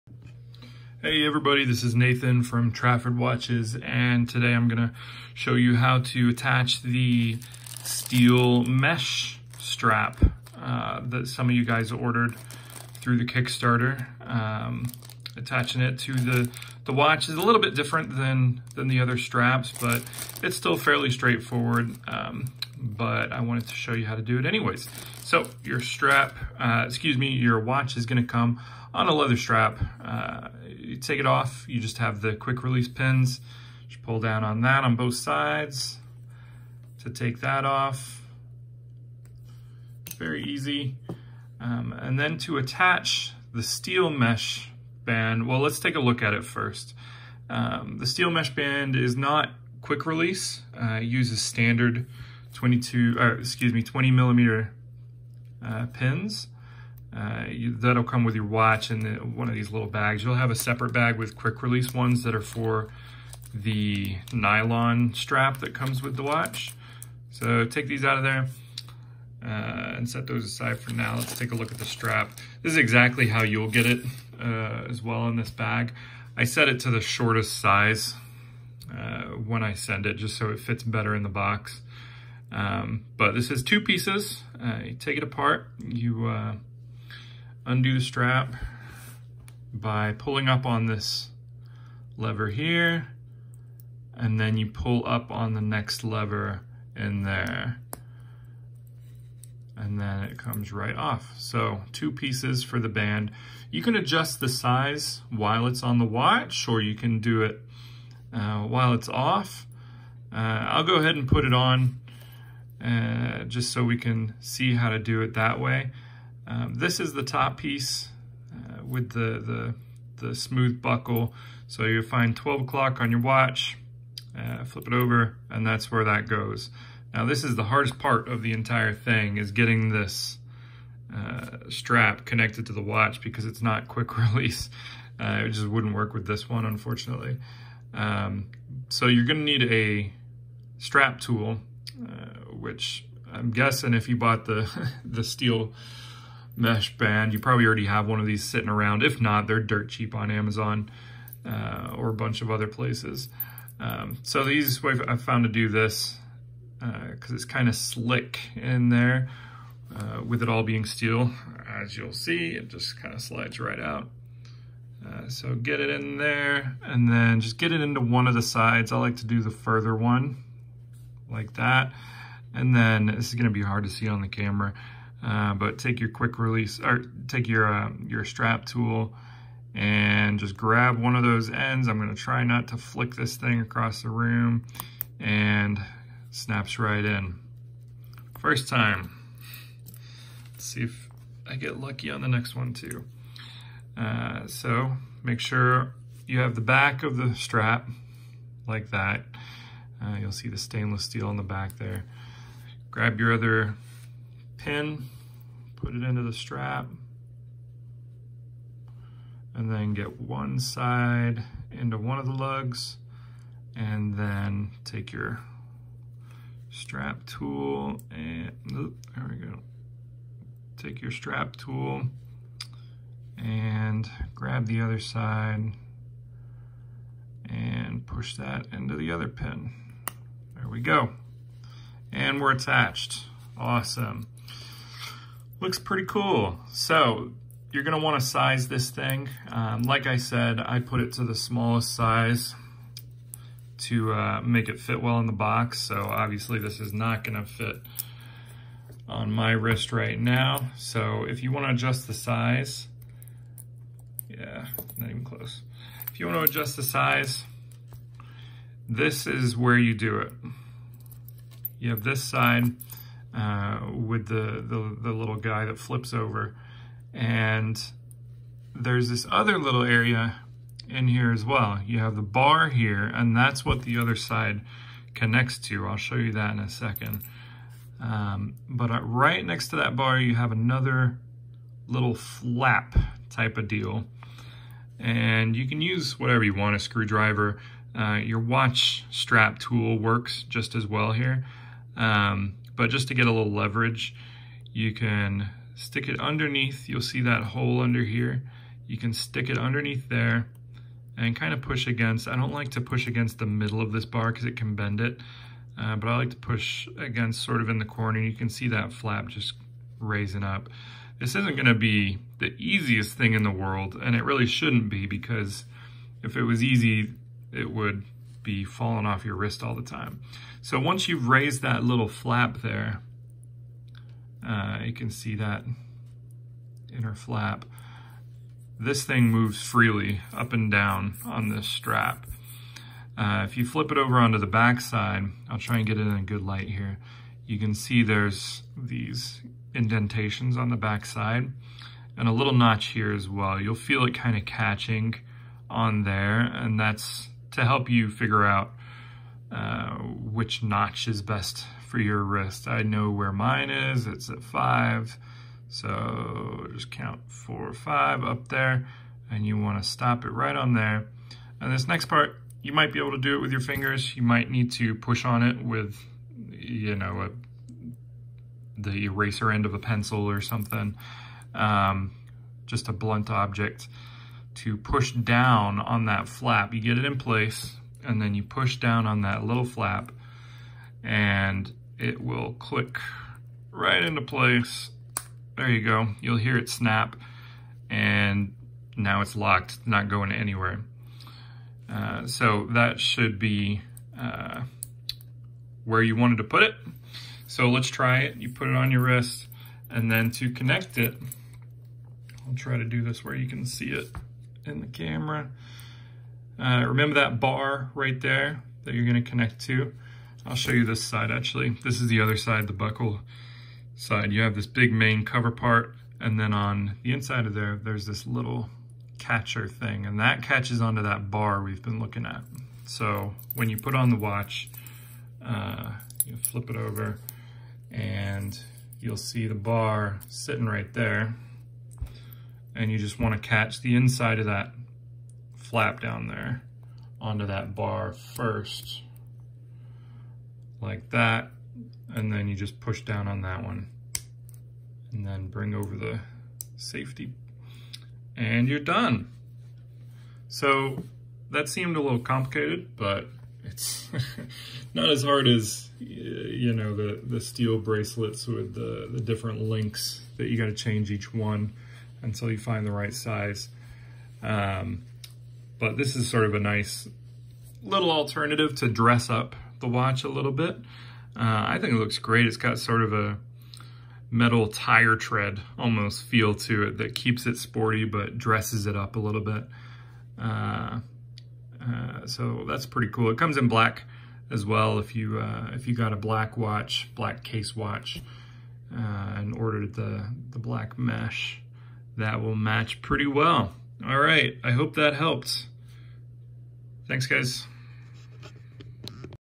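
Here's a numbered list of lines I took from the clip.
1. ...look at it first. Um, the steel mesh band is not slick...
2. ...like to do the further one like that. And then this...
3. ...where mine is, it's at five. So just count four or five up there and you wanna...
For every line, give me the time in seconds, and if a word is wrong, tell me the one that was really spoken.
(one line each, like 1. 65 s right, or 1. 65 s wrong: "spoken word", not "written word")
1. 45 s wrong: "quick", not "slick"
2. 168 s right
3. 353 s right.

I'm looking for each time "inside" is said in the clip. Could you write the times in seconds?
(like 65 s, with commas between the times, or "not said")
417 s, 433 s.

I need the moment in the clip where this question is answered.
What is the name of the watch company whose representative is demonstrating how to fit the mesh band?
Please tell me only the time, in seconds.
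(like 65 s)
2 s.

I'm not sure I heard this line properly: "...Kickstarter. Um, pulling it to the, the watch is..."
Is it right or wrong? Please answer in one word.
wrong.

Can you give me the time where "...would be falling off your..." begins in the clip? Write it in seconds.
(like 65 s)
317 s.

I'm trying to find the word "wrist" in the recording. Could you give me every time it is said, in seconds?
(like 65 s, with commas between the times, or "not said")
249 s, 319 s, 352 s, 399 s.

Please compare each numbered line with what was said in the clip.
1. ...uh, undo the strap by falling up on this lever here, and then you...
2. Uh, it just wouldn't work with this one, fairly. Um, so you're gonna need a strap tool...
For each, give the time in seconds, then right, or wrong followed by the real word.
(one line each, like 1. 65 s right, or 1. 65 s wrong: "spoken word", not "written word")
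1. 86 s wrong: "pulling", not "falling"
2. 135 s wrong: "unfortunately", not "fairly".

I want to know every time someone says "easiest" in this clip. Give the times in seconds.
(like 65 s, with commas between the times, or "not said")
154 s, 312 s.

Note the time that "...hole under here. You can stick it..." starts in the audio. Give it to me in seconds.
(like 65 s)
297 s.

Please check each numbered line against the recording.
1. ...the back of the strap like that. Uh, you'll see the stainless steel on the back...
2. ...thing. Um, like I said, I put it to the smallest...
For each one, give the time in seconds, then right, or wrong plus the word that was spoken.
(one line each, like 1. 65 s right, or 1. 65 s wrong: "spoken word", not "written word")
1. 196 s right
2. 238 s right.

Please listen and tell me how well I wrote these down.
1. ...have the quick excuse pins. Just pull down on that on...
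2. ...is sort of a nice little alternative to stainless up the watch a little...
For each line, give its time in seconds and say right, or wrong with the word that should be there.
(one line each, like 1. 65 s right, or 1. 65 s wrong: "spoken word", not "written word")
1. 31 s wrong: "release", not "excuse"
2. 466 s wrong: "dress", not "stainless".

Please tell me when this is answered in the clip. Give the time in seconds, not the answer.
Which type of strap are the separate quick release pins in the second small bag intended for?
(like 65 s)
64 s.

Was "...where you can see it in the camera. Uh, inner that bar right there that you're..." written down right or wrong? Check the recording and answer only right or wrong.
wrong.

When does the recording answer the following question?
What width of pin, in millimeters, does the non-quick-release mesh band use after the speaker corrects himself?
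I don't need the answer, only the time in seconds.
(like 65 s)
53 s.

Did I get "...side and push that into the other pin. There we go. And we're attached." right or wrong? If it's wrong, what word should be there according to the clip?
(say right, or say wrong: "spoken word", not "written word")
right.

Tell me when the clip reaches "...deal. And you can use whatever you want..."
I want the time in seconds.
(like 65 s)
283 s.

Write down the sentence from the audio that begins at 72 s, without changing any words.
This is exactly how you'll get it uh, as well in this bag.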